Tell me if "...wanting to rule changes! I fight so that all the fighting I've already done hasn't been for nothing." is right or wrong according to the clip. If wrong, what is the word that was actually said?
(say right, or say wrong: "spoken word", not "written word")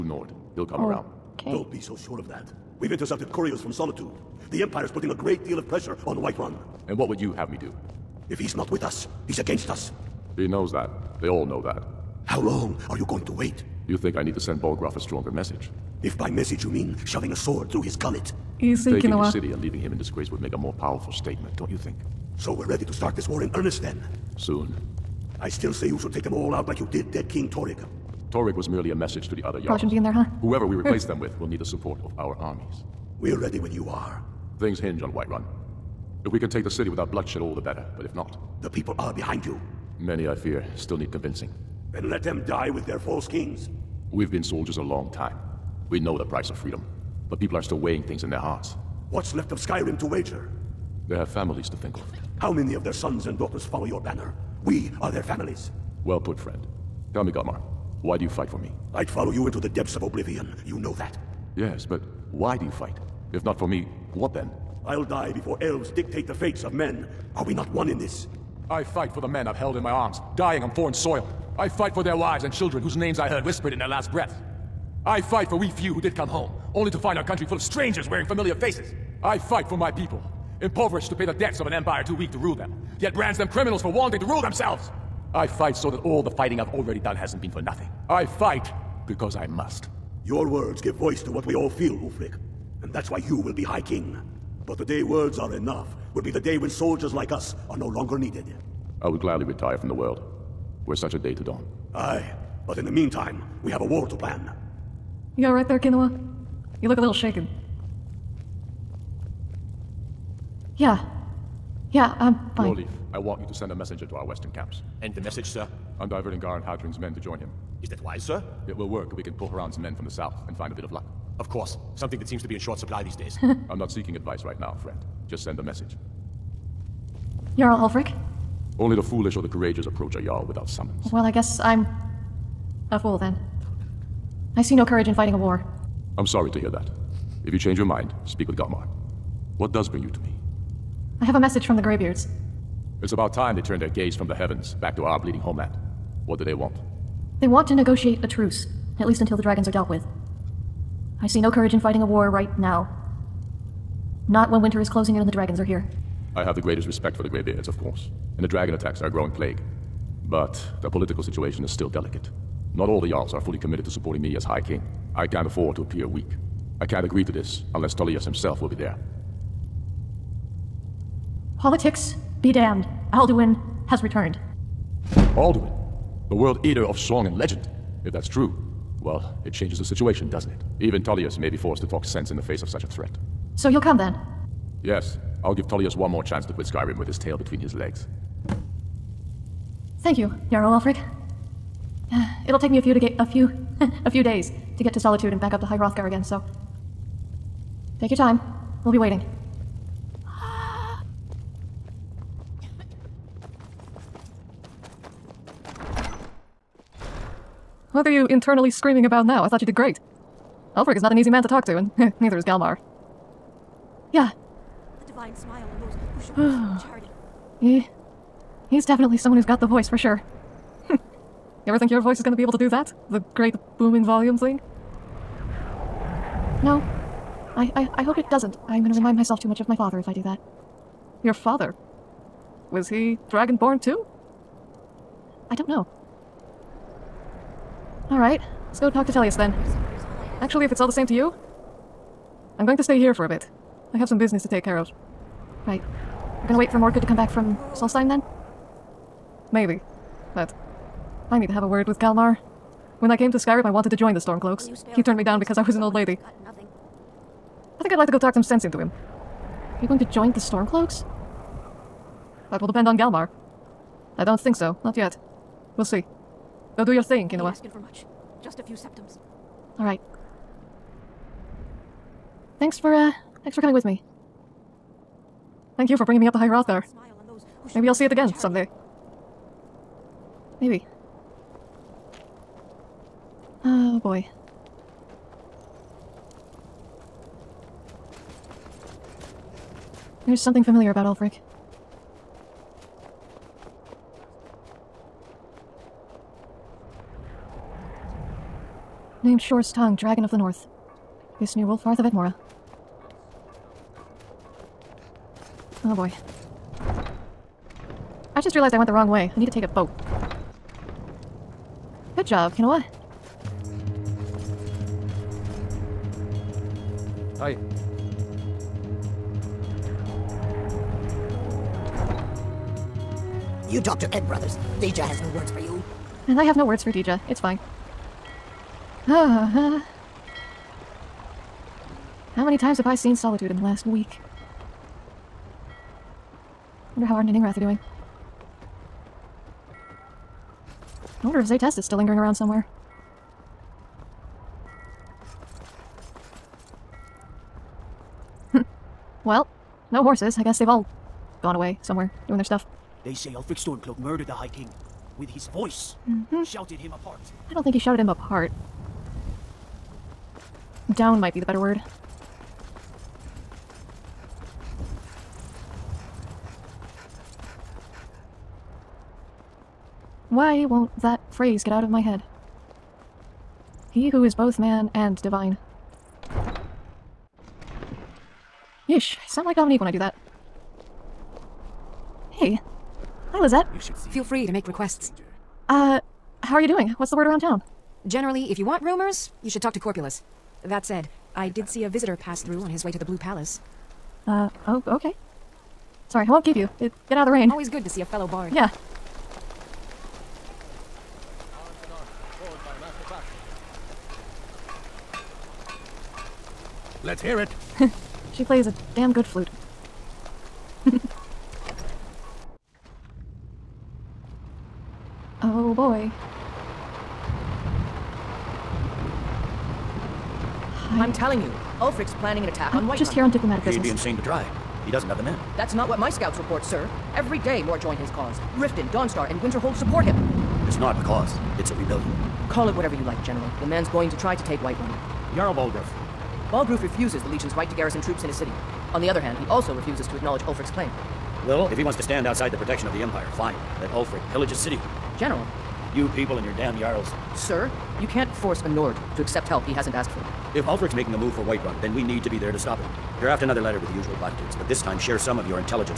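wrong: "themselves", not "changes".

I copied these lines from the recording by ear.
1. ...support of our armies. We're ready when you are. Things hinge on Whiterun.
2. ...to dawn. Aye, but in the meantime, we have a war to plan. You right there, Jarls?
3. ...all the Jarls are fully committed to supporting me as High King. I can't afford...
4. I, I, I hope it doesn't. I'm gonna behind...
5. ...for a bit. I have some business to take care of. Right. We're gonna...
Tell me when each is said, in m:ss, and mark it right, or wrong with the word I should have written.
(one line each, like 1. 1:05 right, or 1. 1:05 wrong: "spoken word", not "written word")
1. 0:31 right
2. 1:41 wrong: "Kinua", not "Jarls"
3. 2:42 right
4. 3:47 wrong: "remind", not "behind"
5. 4:03 right.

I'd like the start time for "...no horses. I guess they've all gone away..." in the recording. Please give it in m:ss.
5:49.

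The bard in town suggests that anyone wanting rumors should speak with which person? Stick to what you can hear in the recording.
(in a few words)
Corpulus.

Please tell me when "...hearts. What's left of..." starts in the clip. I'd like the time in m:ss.
0:48.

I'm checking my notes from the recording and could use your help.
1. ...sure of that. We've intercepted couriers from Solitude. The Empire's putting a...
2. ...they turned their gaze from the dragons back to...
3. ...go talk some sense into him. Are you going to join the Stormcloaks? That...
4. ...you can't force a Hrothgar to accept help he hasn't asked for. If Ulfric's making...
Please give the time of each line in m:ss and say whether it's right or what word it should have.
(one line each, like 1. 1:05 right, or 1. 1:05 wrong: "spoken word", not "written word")
1. 0:01 right
2. 2:23 wrong: "heavens", not "dragons"
3. 4:18 right
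4. 7:28 wrong: "Nord", not "Hrothgar".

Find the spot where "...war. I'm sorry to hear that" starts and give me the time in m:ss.
2:15.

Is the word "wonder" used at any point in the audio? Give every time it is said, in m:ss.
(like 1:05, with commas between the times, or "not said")
5:36, 5:41.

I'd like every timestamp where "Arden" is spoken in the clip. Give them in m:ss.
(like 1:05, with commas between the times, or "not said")
5:37.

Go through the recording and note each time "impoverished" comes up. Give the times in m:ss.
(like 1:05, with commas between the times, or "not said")
1:20.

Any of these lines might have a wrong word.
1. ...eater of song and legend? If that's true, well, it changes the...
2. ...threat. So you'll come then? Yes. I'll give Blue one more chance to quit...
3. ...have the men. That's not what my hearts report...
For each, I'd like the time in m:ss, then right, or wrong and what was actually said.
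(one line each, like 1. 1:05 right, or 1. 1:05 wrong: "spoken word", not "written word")
1. 2:56 right
2. 3:02 wrong: "Tullius", not "Blue"
3. 7:05 wrong: "scouts", not "hearts".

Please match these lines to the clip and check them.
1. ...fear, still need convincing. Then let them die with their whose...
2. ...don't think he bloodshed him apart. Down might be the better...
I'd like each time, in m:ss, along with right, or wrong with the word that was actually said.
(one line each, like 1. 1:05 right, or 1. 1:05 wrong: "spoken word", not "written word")
1. 0:40 wrong: "false", not "whose"
2. 5:57 wrong: "shouted", not "bloodshed".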